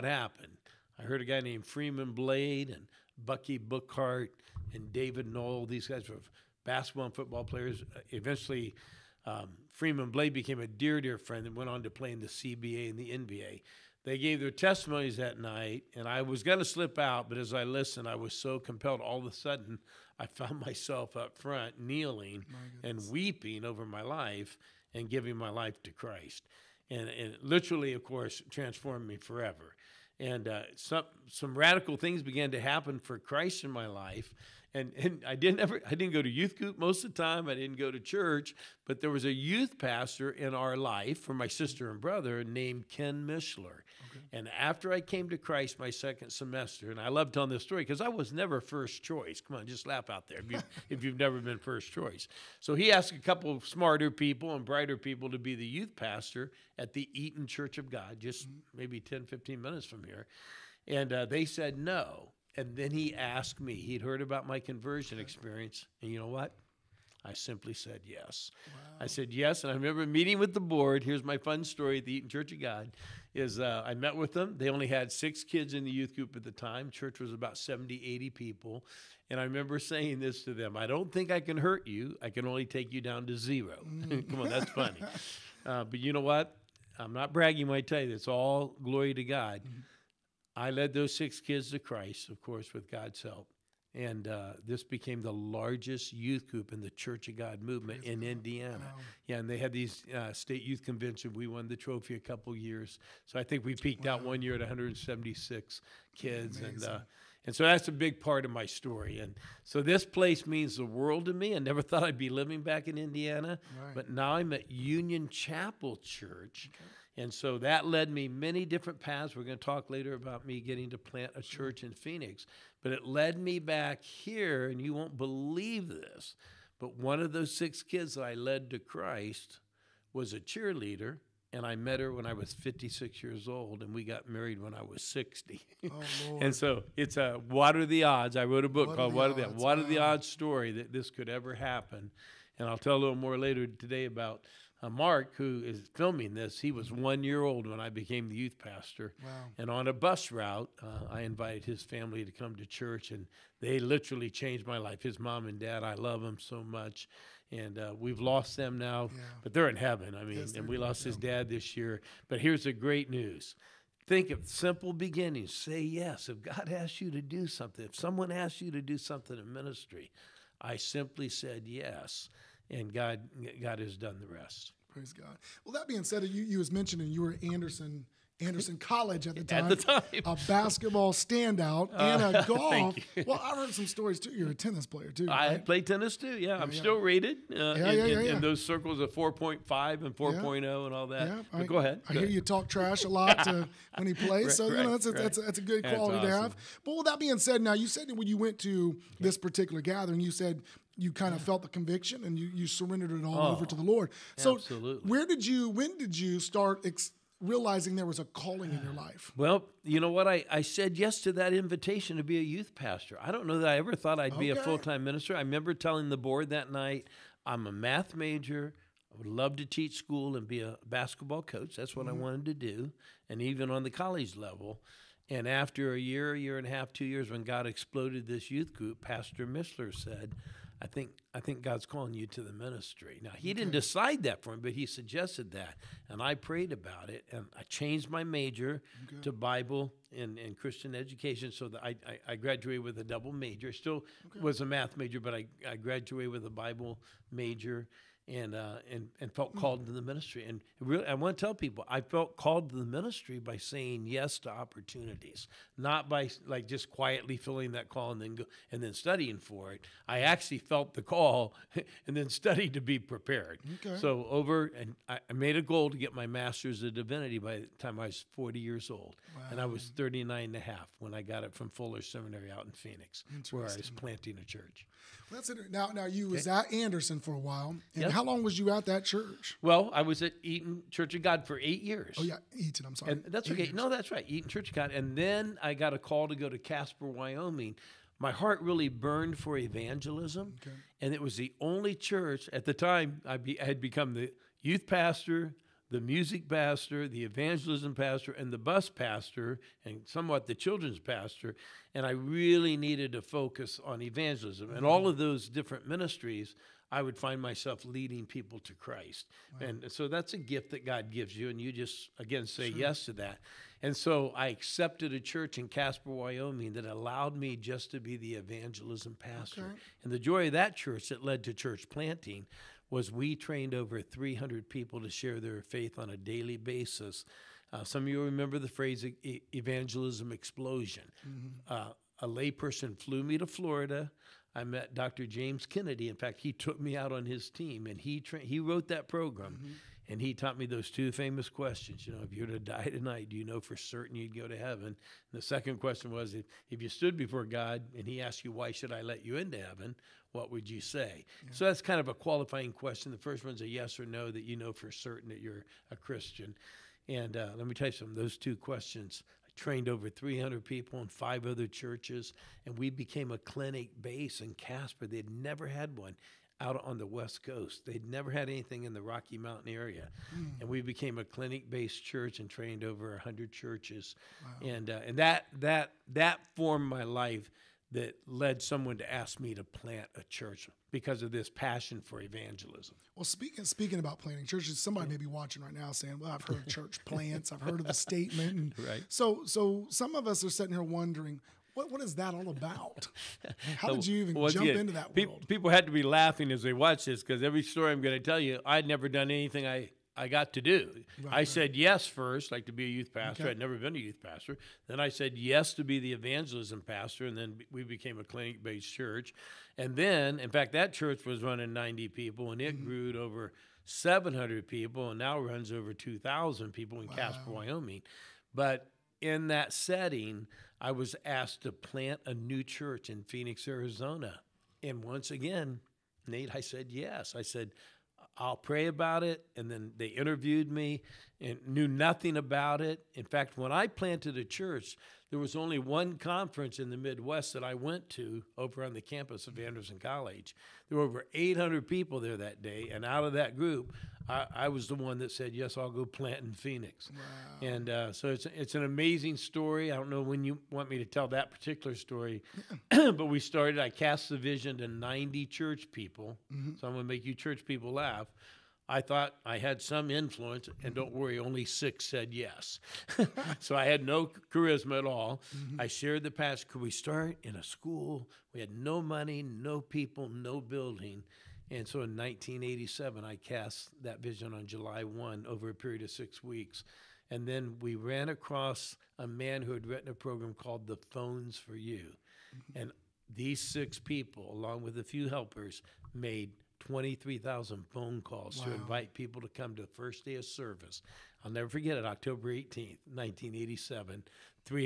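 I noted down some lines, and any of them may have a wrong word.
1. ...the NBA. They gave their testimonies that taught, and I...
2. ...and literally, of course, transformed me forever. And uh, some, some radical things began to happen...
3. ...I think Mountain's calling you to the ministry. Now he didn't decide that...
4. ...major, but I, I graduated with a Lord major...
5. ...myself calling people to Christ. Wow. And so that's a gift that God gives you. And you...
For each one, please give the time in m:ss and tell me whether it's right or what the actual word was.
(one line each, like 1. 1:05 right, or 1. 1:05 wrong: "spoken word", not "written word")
1. 0:12 wrong: "night", not "taught"
2. 0:27 right
3. 3:51 wrong: "God", not "Mountain"
4. 4:04 wrong: "Bible", not "Lord"
5. 5:07 wrong: "leading", not "calling".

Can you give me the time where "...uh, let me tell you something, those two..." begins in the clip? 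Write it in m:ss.
5:57.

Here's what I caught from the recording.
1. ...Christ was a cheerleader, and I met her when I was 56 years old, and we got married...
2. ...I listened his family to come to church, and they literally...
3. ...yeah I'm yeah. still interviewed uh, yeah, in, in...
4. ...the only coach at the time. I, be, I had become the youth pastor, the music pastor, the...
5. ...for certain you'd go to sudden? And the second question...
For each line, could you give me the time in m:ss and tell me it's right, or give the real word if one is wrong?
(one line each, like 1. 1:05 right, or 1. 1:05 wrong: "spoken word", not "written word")
1. 2:08 right
2. 2:31 wrong: "invited", not "listened"
3. 3:06 wrong: "rated", not "interviewed"
4. 4:51 wrong: "church", not "coach"
5. 5:43 wrong: "heaven", not "sudden".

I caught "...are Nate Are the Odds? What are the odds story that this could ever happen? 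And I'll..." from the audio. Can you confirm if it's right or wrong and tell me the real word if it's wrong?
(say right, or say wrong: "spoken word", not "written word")
wrong: "What", not "Nate".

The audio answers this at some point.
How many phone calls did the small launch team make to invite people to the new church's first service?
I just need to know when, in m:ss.
8:06.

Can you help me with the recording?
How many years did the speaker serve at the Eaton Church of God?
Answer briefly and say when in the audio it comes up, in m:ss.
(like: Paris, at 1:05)
8, at 4:41.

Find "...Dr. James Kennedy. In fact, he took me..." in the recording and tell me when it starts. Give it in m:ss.
5:34.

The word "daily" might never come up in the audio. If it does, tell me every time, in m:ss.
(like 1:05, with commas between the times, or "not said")
5:26.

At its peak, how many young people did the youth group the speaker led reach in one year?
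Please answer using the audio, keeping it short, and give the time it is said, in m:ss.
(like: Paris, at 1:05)
176, at 1:44.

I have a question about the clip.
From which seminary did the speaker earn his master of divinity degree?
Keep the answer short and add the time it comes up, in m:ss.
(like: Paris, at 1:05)
Fuller Seminary, at 4:31.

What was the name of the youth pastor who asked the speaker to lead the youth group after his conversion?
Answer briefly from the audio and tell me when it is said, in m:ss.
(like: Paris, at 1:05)
Ken Mishler, at 0:42.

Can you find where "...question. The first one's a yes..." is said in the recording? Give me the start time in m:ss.
5:52.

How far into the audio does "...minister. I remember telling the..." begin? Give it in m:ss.
3:35.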